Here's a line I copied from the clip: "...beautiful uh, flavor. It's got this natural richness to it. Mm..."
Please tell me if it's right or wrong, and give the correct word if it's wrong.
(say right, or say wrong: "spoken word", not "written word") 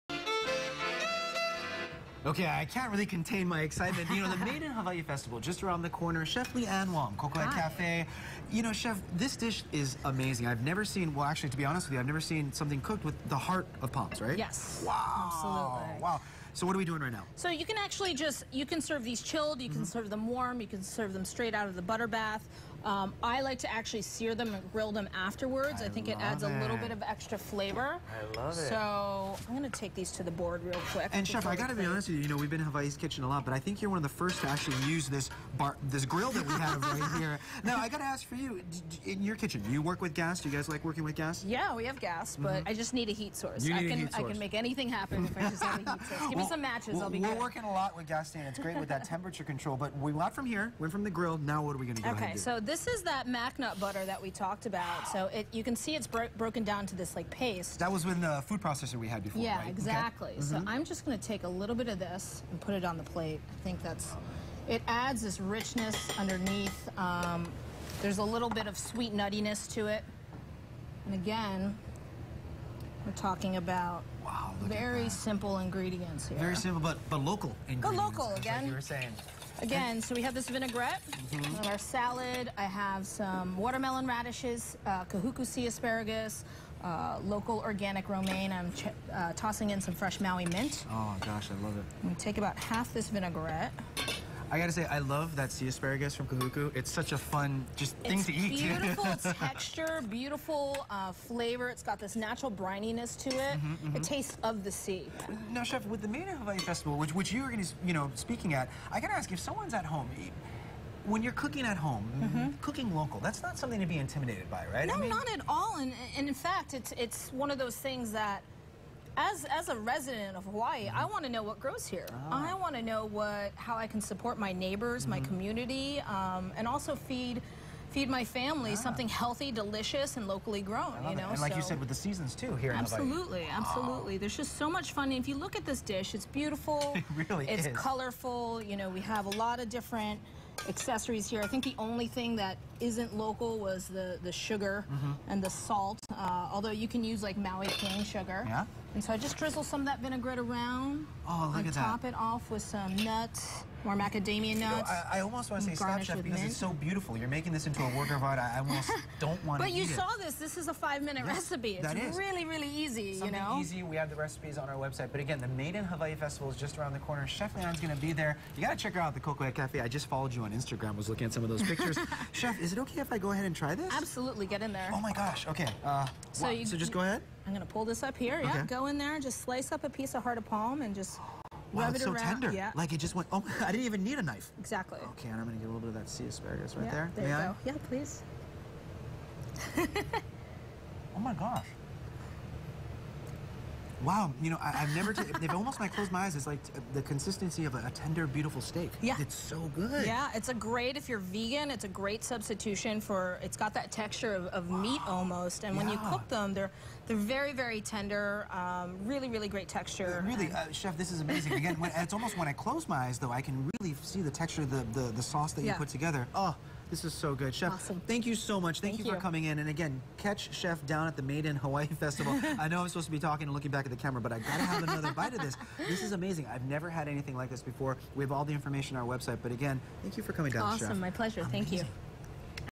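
wrong: "brininess", not "richness".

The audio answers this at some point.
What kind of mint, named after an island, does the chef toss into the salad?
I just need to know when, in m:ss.
1:30.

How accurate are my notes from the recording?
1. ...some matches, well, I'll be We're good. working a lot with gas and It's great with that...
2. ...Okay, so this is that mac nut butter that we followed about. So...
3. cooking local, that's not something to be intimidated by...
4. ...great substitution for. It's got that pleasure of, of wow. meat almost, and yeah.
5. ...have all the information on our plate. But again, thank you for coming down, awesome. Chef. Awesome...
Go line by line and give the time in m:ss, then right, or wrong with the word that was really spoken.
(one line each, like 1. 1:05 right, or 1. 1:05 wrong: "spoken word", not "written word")
1. 0:46 right
2. 0:52 wrong: "talked", not "followed"
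3. 1:52 right
4. 3:21 wrong: "texture", not "pleasure"
5. 3:48 wrong: "website", not "plate".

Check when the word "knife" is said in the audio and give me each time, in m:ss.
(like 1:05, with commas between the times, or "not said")
3:04.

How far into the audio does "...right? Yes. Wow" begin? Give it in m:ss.
0:14.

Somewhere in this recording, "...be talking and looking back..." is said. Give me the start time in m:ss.
3:43.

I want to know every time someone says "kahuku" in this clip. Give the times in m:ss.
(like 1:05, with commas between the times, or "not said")
1:25, 1:36.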